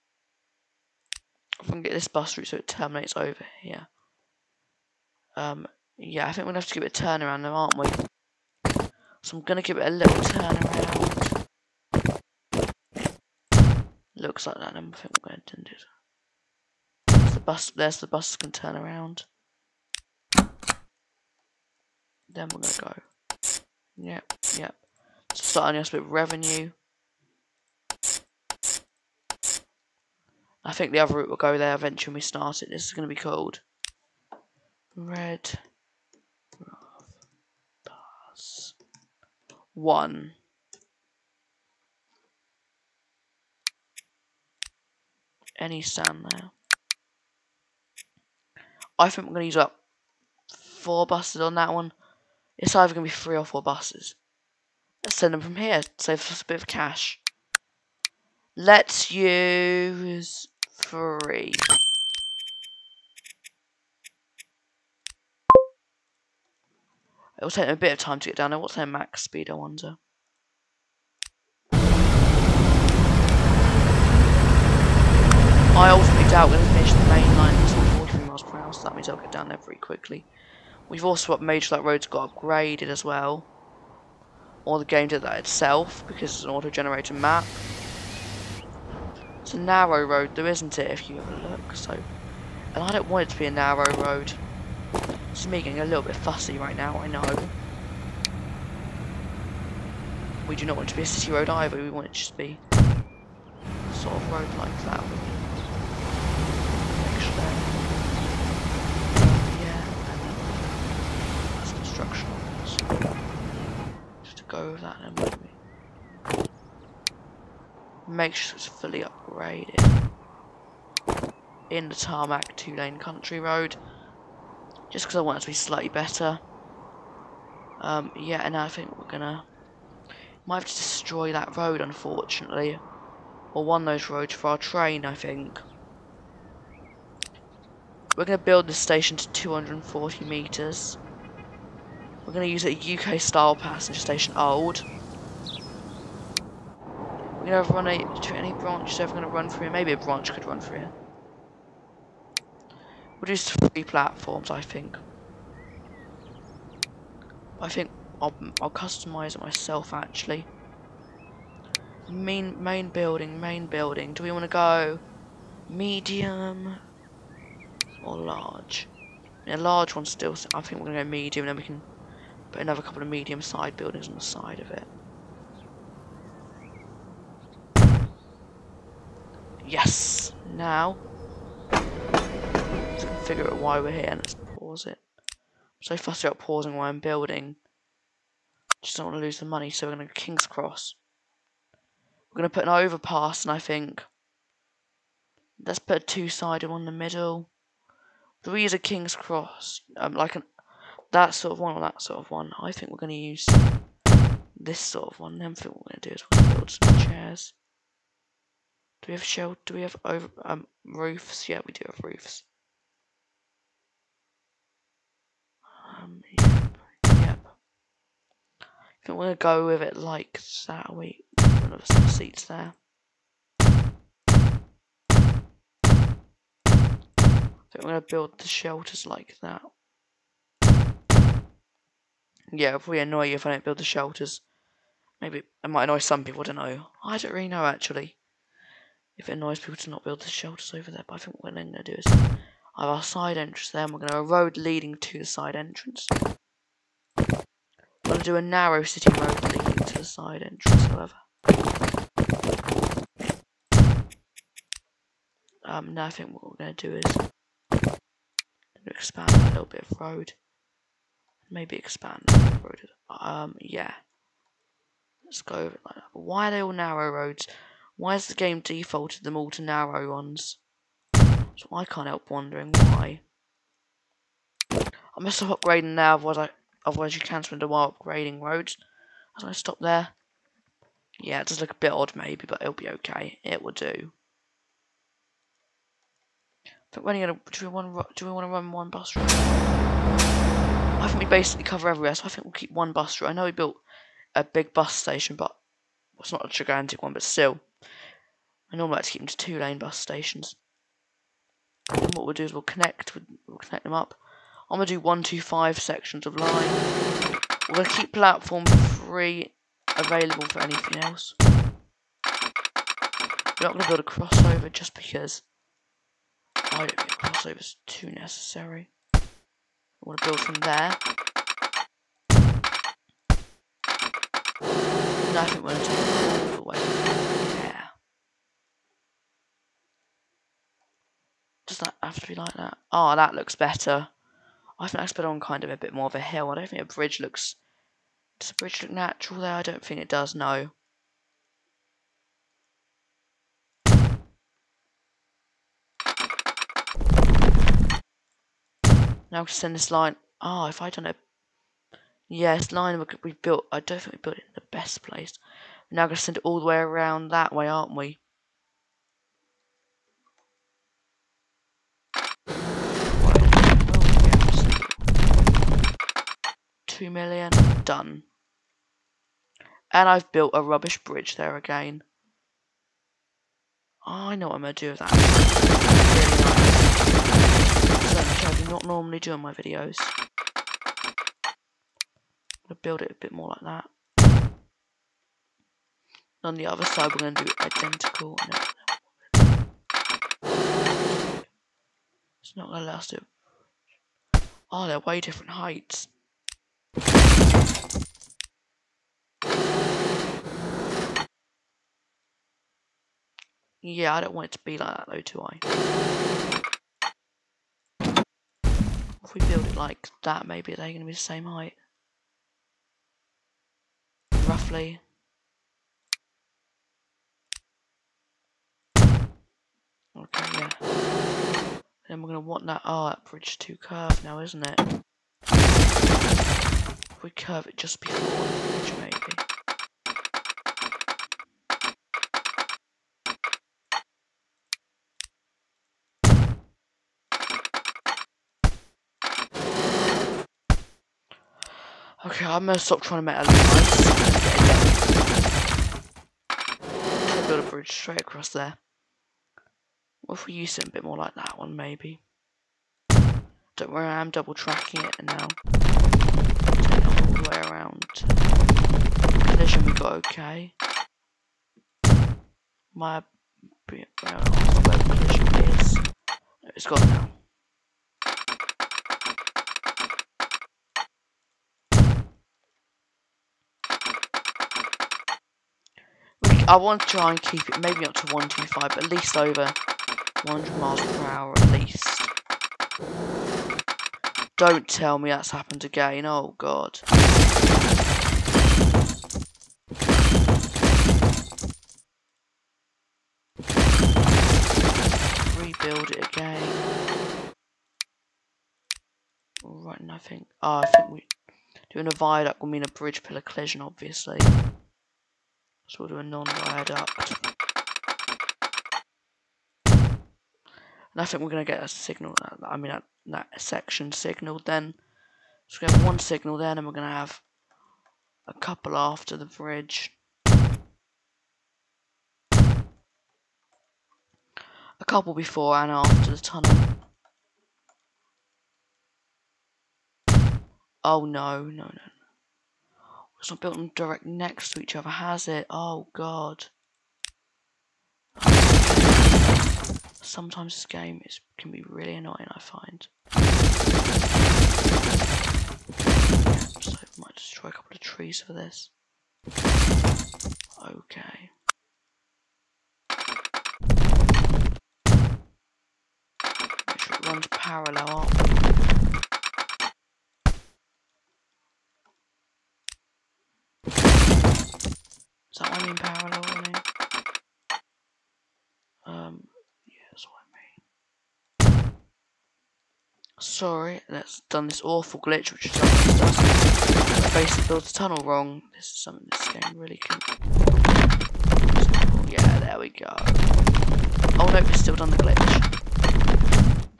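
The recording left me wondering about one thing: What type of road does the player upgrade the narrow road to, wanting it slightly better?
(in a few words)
Tarmac two lane country road.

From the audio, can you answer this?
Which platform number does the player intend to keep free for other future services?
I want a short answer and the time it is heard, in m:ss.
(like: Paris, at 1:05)
3, at 5:08.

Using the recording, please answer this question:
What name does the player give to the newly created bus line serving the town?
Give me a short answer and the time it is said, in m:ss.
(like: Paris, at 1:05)
Red Bus 1, at 0:34.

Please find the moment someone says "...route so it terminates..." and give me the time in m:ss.
0:02.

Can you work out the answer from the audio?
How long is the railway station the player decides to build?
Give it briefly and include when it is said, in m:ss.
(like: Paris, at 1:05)
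240 metres, at 2:19.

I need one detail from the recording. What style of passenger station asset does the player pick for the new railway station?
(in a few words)
UK style passenger station old.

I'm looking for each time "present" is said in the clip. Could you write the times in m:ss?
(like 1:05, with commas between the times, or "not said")
not said.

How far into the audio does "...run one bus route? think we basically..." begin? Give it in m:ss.
4:48.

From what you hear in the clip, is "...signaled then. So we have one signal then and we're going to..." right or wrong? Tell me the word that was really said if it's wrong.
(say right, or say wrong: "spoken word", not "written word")
right.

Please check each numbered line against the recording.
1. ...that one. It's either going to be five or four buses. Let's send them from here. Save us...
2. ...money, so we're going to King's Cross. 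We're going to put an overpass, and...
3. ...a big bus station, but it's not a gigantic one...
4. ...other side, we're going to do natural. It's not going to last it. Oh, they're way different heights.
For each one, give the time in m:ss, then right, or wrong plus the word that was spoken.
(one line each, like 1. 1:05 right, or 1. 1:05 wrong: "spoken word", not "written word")
1. 0:51 wrong: "three", not "five"
2. 3:09 right
3. 4:54 right
4. 6:26 wrong: "identical", not "natural".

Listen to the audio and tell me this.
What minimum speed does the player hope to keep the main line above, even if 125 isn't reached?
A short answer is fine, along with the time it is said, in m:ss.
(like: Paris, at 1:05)
100 miles per hour, at 8:00.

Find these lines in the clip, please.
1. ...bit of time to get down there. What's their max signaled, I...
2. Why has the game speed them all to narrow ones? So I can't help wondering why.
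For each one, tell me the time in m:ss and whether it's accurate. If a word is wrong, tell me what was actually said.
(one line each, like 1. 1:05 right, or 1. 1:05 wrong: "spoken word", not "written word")
1. 1:07 wrong: "speed", not "signaled"
2. 4:27 wrong: "defaulted", not "speed".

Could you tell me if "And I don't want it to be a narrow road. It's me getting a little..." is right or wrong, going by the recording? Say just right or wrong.
right.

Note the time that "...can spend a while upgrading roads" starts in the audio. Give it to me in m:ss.
4:37.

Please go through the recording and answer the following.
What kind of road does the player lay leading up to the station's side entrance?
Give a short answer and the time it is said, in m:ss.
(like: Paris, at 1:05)
Narrow city road, at 4:08.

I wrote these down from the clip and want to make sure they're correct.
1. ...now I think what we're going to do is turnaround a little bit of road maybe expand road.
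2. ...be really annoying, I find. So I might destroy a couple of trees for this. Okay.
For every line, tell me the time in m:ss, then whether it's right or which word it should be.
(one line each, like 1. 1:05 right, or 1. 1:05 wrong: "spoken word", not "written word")
1. 4:15 wrong: "expand", not "turnaround"
2. 9:01 right.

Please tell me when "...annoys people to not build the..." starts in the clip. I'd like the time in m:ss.
3:59.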